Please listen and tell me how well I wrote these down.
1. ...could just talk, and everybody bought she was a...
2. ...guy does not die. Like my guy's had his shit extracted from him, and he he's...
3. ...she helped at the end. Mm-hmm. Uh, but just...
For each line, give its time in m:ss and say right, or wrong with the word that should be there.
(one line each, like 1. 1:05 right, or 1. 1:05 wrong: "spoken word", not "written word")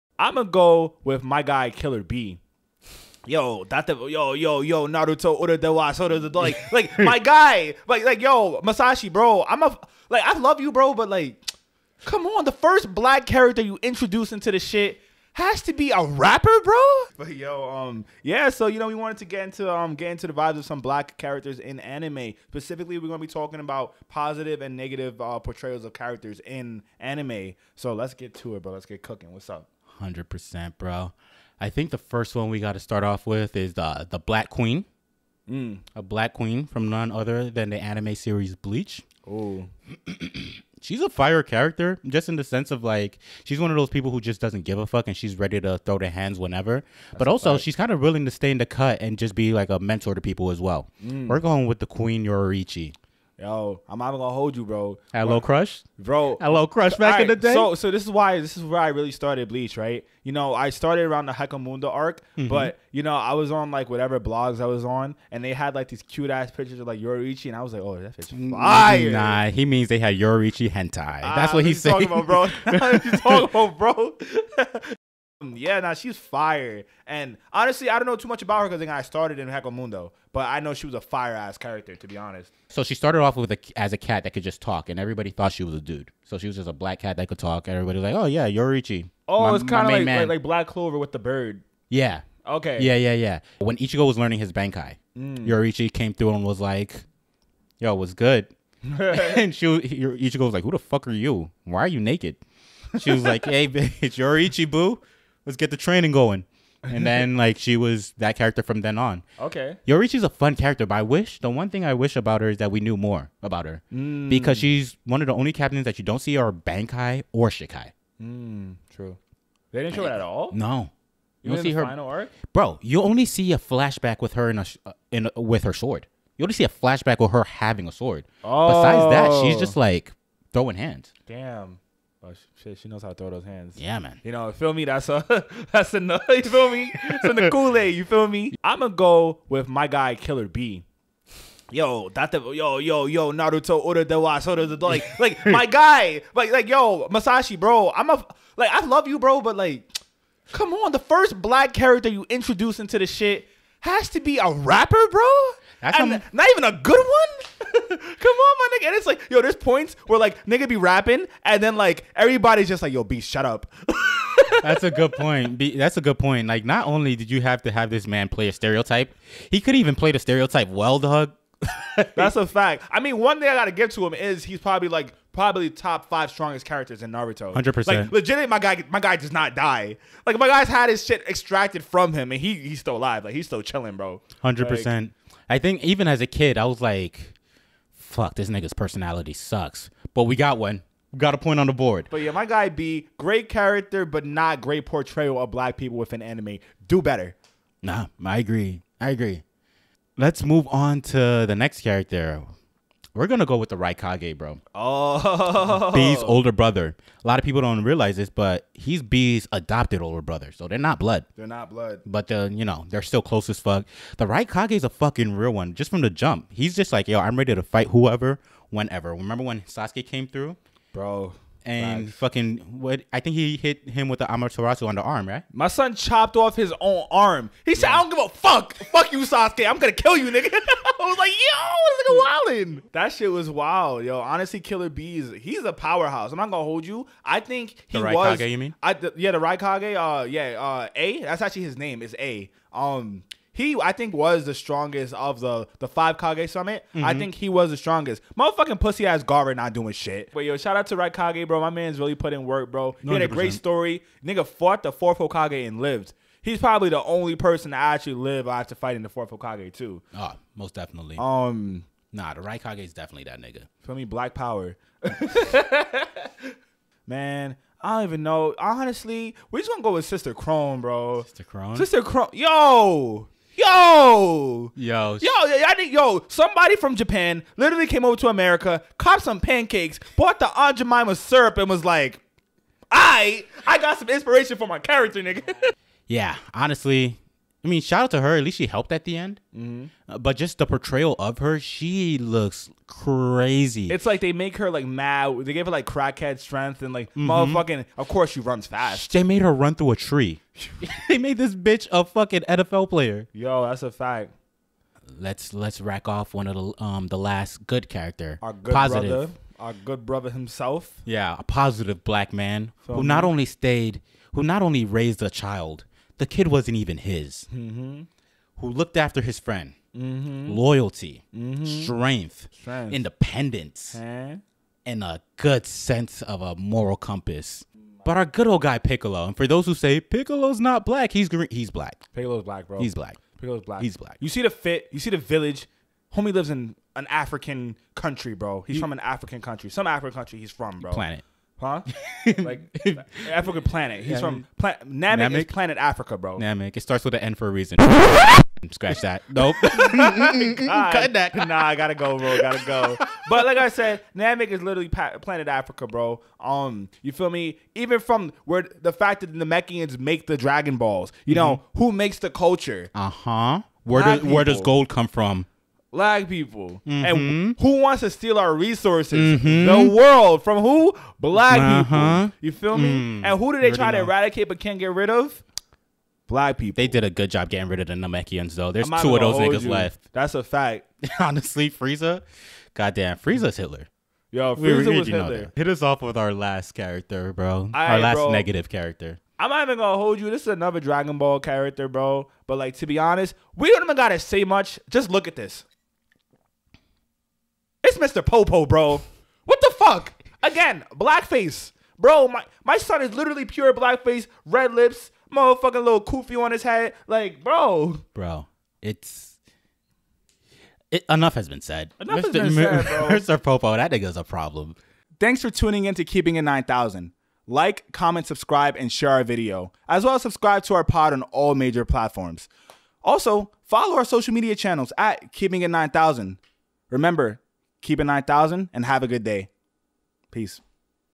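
1. 1:24 wrong: "thought", not "bought"
2. 2:58 right
3. 4:48 right.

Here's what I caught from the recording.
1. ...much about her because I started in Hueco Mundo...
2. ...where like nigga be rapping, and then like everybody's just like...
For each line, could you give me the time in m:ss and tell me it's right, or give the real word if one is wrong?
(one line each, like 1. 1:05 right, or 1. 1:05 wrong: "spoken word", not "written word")
1. 1:18 right
2. 2:40 right.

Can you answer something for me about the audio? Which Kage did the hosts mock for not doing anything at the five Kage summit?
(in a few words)
Gaara.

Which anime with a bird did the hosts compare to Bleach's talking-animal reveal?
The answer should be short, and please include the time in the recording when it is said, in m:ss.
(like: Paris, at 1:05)
Black Clover, at 1:30.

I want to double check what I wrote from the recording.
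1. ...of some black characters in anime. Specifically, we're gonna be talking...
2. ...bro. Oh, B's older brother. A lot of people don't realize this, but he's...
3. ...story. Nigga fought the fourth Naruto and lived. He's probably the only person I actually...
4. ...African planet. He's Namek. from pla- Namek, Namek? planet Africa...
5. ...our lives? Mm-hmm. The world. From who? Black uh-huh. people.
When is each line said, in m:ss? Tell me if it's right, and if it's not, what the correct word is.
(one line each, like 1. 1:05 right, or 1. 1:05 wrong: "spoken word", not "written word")
1. 0:20 right
2. 3:24 right
3. 4:13 wrong: "Hokage", not "Naruto"
4. 5:43 right
5. 6:08 wrong: "resources", not "lives".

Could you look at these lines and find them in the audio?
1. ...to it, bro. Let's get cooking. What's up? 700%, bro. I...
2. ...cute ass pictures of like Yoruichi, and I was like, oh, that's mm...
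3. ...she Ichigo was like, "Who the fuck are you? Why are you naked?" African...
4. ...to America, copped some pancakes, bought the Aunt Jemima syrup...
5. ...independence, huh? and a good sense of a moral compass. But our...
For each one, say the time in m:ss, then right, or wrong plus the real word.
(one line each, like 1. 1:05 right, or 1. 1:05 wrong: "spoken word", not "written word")
1. 0:28 wrong: "100", not "700"
2. 1:06 right
3. 1:39 wrong: "She", not "African"
4. 4:38 right
5. 5:22 right.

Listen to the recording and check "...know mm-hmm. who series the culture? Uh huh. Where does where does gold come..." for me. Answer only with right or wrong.
wrong.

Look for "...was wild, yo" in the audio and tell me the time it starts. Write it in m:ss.
3:53.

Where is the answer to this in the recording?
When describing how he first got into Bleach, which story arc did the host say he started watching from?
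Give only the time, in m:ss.
1:01.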